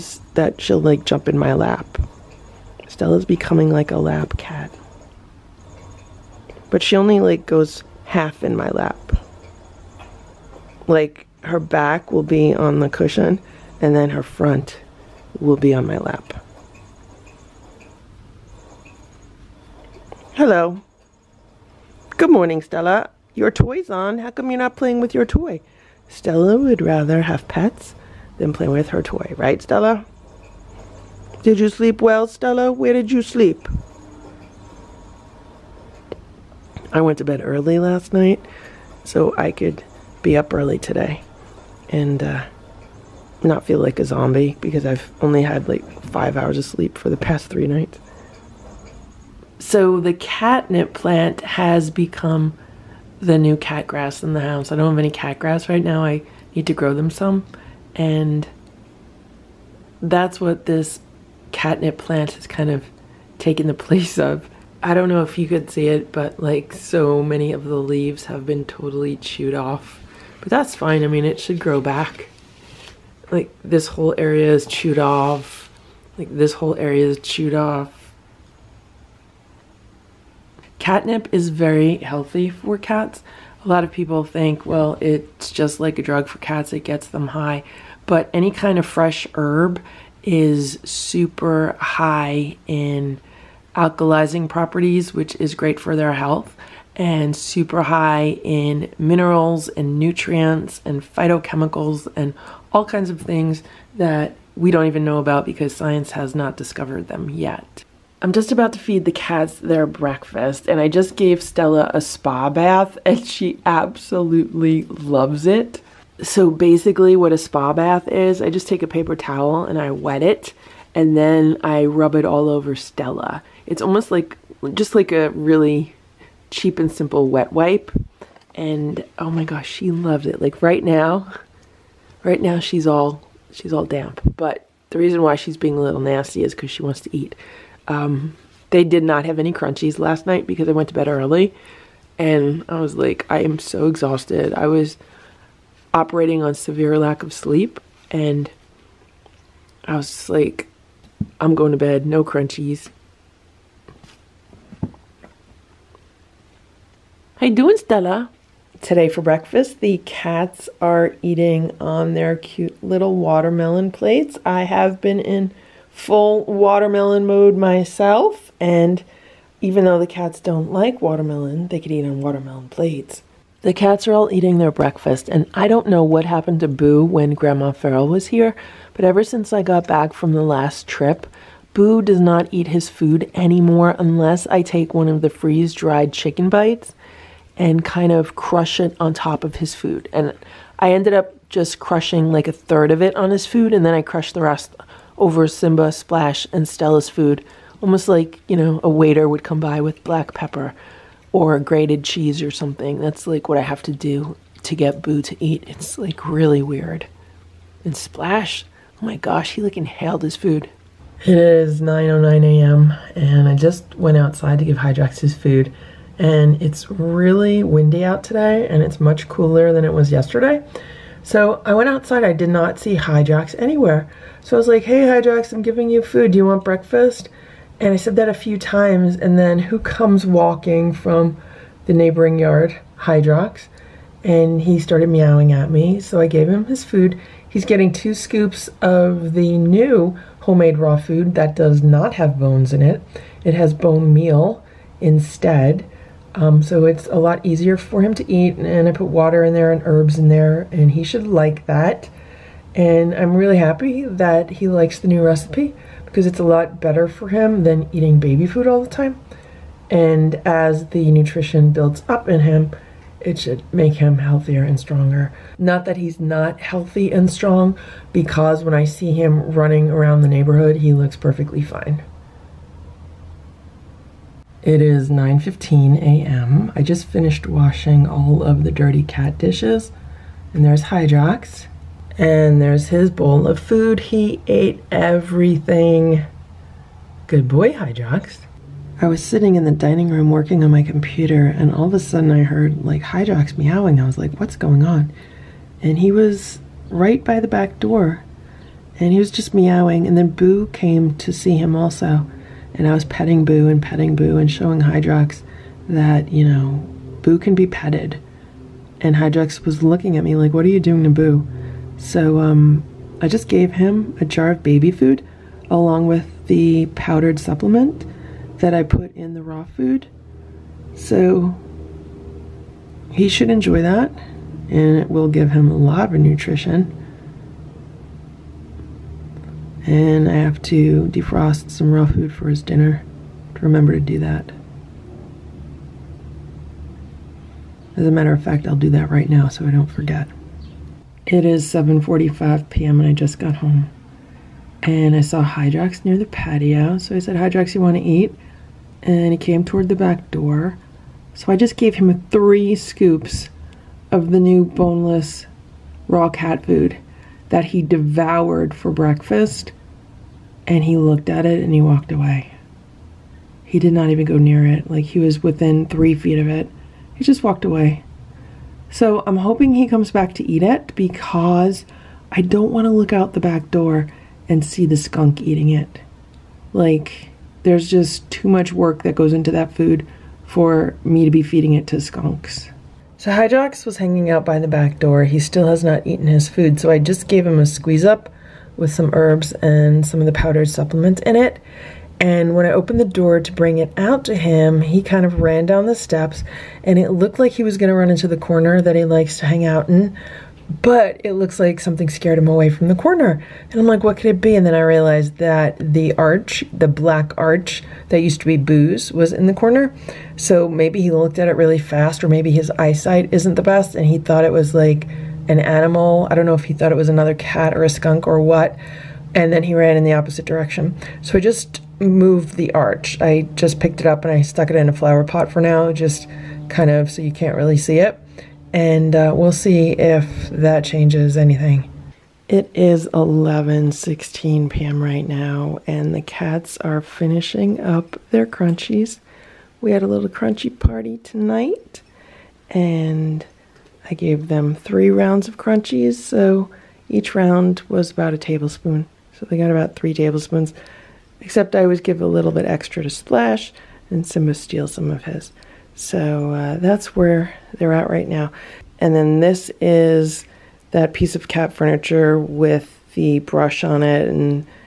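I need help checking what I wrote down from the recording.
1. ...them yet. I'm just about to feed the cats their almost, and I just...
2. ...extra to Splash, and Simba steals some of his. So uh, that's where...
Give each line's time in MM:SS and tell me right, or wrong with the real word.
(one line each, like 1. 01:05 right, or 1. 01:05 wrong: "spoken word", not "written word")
1. 01:47 wrong: "breakfast", not "almost"
2. 07:32 right.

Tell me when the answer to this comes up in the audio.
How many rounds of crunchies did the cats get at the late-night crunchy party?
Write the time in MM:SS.
07:24.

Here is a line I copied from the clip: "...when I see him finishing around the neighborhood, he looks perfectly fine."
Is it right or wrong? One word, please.
wrong.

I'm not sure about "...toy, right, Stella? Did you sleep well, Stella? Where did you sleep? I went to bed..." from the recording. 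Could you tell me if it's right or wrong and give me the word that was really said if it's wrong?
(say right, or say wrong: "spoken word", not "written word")
right.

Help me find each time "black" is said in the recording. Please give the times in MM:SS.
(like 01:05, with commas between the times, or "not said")
03:20, 06:46.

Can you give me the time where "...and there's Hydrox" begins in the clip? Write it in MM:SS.
04:40.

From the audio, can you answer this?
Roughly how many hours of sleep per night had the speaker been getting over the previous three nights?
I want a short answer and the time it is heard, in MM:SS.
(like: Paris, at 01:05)
5, at 00:46.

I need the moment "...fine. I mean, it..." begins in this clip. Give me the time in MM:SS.
01:10.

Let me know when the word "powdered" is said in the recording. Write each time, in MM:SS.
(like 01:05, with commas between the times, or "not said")
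05:16, 06:30.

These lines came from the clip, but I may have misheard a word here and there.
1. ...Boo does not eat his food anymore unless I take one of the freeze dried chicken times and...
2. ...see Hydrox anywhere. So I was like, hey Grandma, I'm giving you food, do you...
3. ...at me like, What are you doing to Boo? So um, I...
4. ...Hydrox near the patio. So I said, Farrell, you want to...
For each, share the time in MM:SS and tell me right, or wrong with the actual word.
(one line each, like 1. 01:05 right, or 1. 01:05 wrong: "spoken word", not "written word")
1. 03:01 wrong: "bites", not "times"
2. 03:42 wrong: "Hydrox", not "Grandma"
3. 05:10 right
4. 05:45 wrong: "Hydrox", not "Farrell".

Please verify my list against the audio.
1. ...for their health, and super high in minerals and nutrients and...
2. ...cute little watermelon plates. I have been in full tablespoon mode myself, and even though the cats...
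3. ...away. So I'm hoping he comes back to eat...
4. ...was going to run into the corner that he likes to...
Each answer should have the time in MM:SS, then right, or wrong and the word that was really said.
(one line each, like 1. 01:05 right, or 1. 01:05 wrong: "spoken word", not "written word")
1. 01:35 right
2. 02:42 wrong: "watermelon", not "tablespoon"
3. 06:07 right
4. 06:37 right.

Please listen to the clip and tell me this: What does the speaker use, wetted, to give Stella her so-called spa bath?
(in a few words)
A paper towel.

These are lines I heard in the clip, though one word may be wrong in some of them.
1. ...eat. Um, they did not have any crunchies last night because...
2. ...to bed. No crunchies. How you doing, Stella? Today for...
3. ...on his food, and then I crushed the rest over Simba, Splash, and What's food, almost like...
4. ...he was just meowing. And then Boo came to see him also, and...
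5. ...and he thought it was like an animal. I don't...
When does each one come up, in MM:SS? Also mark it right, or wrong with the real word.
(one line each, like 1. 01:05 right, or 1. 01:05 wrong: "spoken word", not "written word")
1. 02:17 right
2. 02:31 right
3. 03:13 wrong: "Stella", not "What"
4. 04:59 right
5. 06:53 right.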